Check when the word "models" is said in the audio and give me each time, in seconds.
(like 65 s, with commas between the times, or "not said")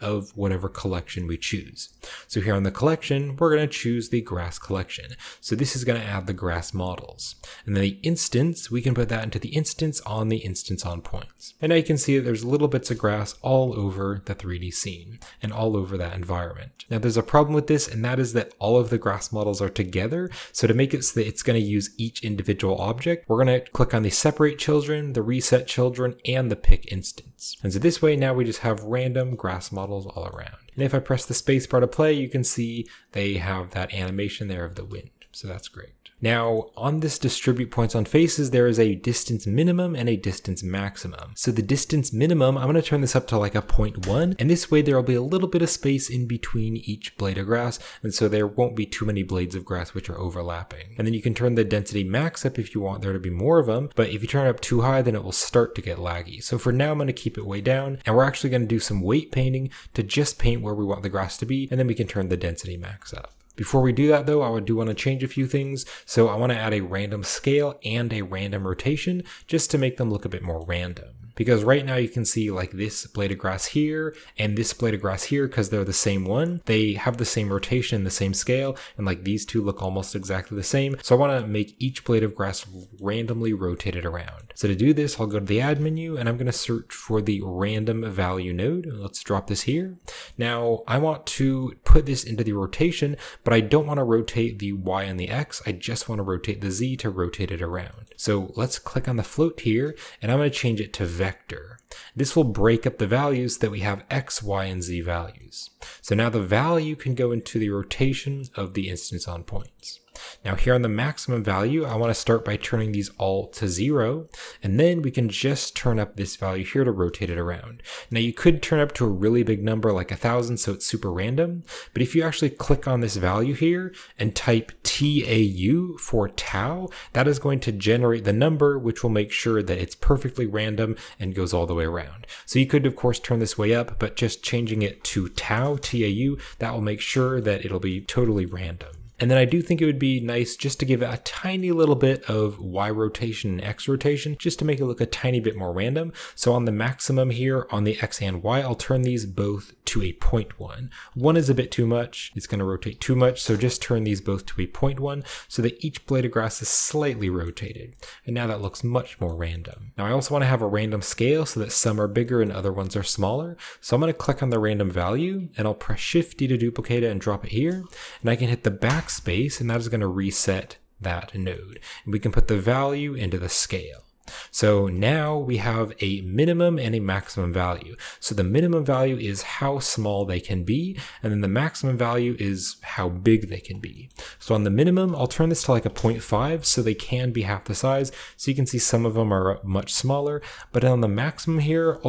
6 s, 19 s, 29 s.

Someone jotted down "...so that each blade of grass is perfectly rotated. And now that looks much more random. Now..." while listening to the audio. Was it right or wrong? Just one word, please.
wrong.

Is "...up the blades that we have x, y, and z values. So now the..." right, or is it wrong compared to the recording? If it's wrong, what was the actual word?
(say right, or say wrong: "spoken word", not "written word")
wrong: "values", not "blades".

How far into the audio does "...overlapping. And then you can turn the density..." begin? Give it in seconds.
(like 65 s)
50 s.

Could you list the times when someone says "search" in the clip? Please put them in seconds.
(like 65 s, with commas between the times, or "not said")
86 s.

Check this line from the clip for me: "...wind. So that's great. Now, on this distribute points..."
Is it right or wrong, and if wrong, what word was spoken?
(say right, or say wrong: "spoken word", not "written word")
right.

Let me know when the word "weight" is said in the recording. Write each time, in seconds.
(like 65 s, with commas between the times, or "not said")
59 s.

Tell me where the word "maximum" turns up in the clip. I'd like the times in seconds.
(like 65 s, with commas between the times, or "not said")
40 s, 110 s, 146 s, 176 s, 181 s, 191 s.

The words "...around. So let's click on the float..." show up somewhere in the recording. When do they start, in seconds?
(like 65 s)
97 s.